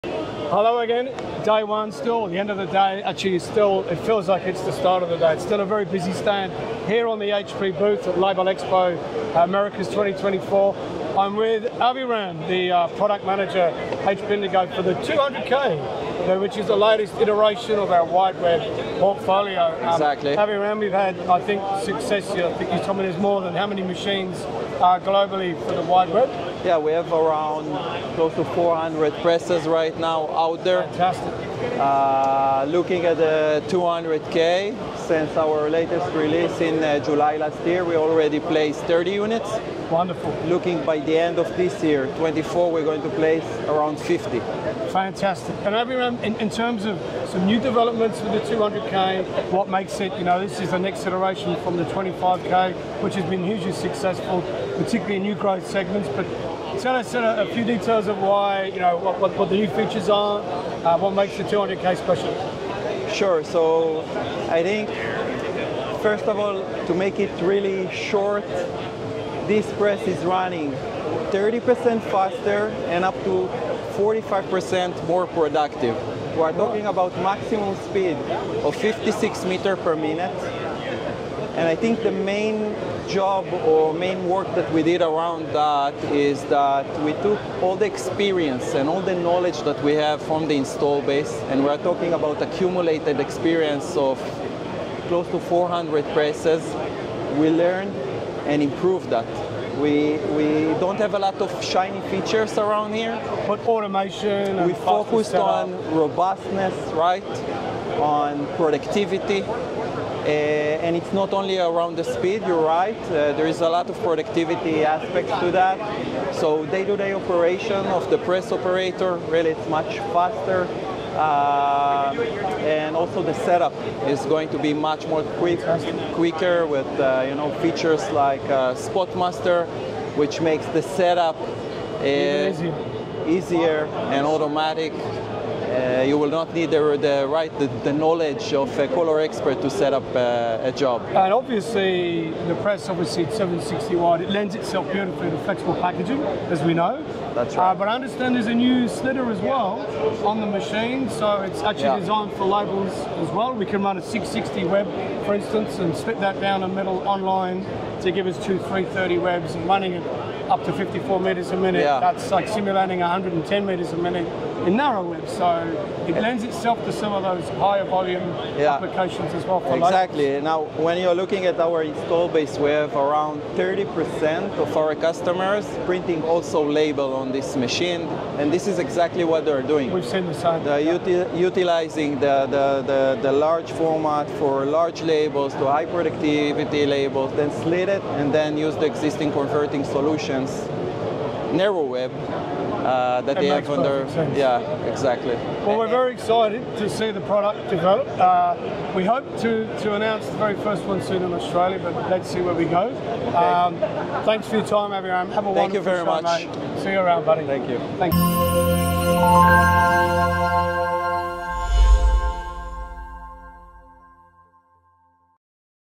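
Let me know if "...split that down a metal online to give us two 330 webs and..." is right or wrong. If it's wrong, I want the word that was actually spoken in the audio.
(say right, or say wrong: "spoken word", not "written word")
right.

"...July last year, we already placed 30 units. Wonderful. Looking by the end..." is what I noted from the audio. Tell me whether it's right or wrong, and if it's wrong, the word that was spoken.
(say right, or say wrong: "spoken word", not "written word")
right.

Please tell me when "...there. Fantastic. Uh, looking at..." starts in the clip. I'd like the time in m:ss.
0:30.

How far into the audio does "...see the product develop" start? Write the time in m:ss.
3:16.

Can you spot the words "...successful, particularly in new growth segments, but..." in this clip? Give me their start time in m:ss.
0:53.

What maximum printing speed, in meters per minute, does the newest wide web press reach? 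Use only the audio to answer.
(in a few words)
56 meters per minute.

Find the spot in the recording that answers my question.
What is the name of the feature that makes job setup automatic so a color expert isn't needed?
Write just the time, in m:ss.
2:08.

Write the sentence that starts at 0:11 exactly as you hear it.
I'm with Aviram, the uh, product manager, HP Indigo, for the 200K, which is the latest iteration of our wide web portfolio.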